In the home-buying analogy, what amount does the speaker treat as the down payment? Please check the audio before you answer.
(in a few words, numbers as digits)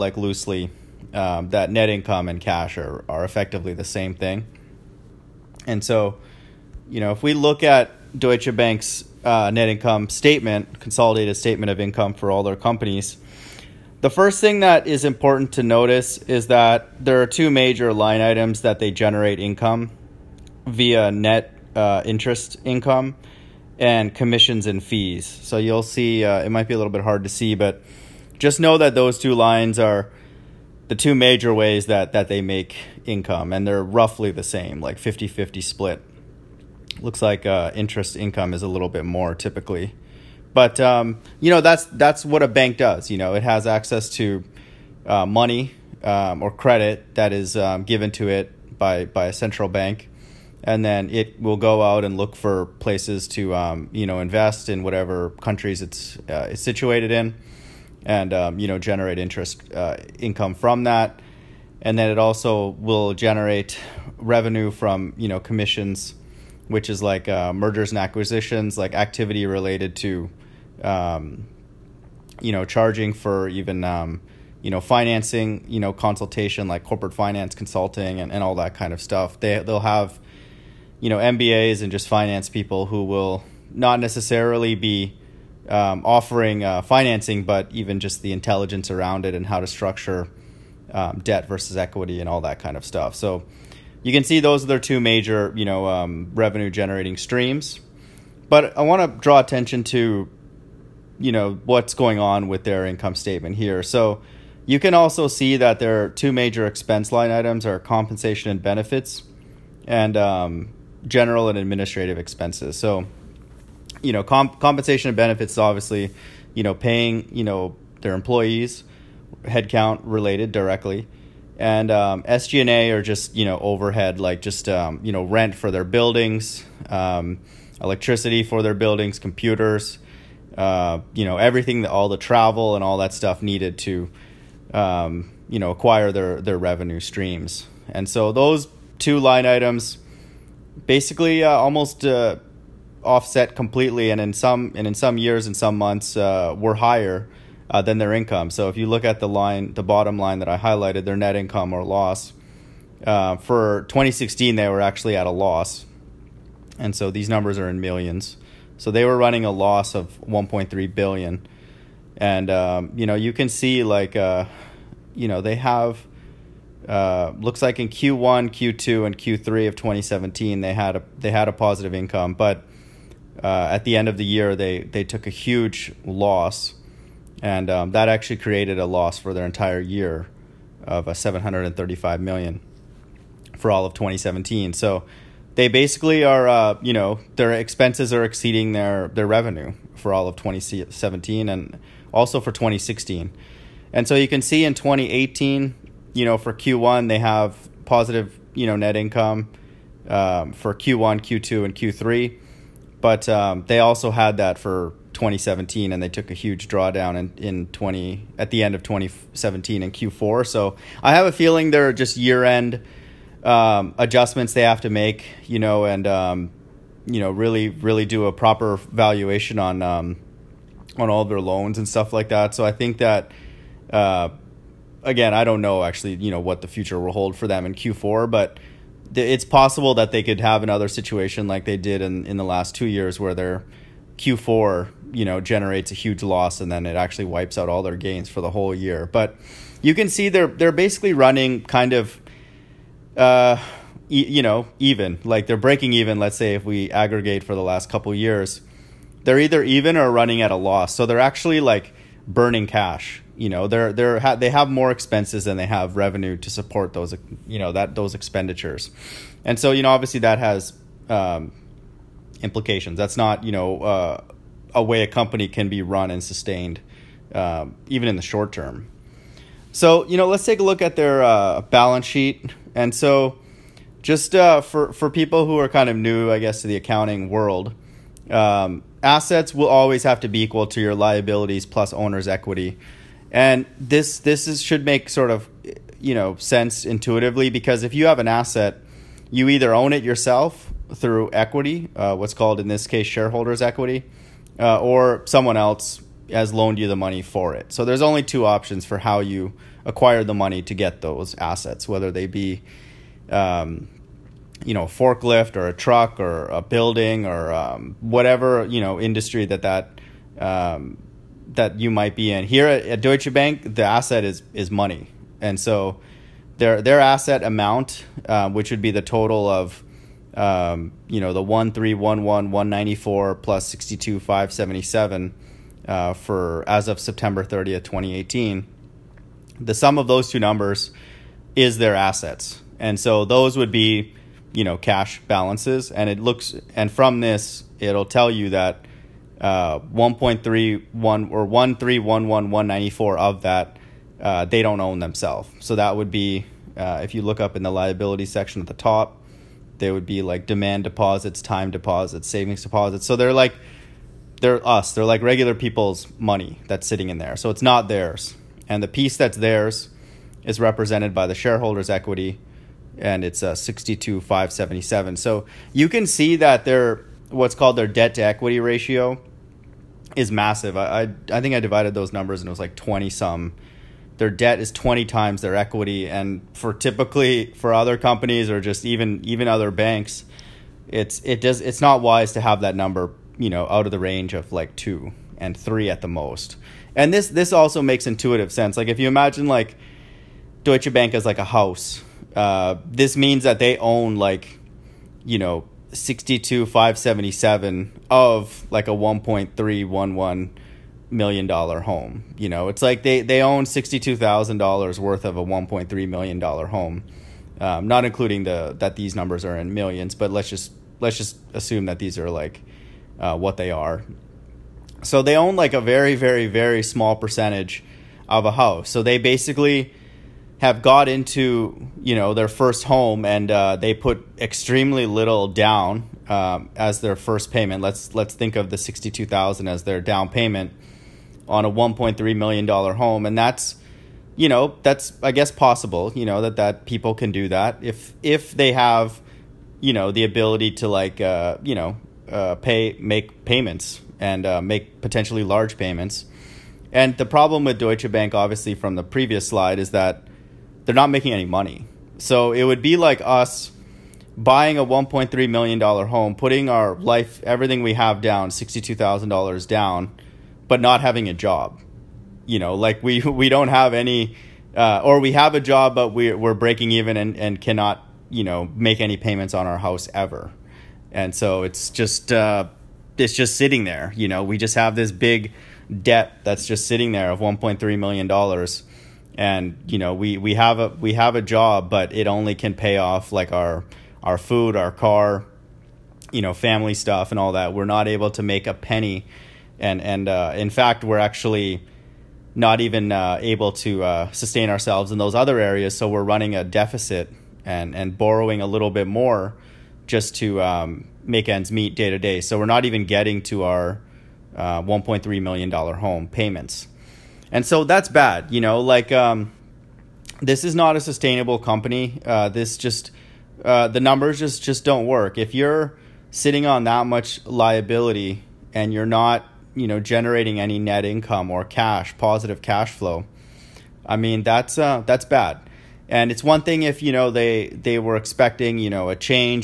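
$62,000.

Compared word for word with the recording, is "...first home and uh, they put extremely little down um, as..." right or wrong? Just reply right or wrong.
right.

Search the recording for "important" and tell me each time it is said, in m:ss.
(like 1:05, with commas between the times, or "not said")
0:15.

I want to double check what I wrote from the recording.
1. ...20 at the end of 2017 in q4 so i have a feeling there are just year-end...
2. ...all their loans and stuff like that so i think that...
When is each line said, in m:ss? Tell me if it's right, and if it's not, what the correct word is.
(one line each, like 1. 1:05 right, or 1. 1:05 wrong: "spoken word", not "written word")
1. 3:27 right
2. 3:41 right.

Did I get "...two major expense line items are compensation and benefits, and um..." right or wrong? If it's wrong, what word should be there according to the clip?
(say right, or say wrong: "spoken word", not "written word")
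right.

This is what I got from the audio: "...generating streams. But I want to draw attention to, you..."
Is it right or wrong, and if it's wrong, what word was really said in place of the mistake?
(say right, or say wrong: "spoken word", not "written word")
right.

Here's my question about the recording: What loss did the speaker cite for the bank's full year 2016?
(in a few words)
1.3 billion.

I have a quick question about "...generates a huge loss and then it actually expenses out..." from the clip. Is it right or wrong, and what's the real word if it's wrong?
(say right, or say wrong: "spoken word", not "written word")
wrong: "wipes", not "expenses".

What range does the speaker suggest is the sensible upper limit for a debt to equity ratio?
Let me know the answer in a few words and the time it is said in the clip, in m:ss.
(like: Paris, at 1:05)
2 and 3, at 6:24.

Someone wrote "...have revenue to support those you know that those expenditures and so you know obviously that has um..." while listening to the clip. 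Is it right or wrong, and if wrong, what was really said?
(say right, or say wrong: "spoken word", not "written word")
right.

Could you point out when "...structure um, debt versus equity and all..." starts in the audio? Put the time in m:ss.
1:29.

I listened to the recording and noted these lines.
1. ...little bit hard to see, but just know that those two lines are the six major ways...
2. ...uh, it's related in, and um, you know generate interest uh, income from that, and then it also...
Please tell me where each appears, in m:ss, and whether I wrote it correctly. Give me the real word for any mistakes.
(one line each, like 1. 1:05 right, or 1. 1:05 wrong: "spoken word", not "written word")
1. 0:26 wrong: "two", not "six"
2. 0:56 wrong: "situated", not "related".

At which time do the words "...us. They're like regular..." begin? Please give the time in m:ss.
5:54.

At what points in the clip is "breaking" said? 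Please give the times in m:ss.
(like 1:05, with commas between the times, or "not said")
4:05, 7:46.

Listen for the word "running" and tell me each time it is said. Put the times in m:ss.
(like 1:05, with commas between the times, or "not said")
2:39, 4:01, 4:10, 8:16.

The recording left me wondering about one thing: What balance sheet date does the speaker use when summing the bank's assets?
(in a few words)
September 30th, 2018.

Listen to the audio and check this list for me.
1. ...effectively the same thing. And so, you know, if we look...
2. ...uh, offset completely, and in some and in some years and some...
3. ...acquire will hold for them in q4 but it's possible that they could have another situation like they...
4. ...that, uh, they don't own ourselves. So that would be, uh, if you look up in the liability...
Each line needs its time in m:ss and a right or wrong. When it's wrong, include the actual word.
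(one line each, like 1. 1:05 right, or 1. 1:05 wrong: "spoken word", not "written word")
1. 0:03 right
2. 2:22 right
3. 3:46 wrong: "future", not "acquire"
4. 5:43 wrong: "themselves", not "ourselves".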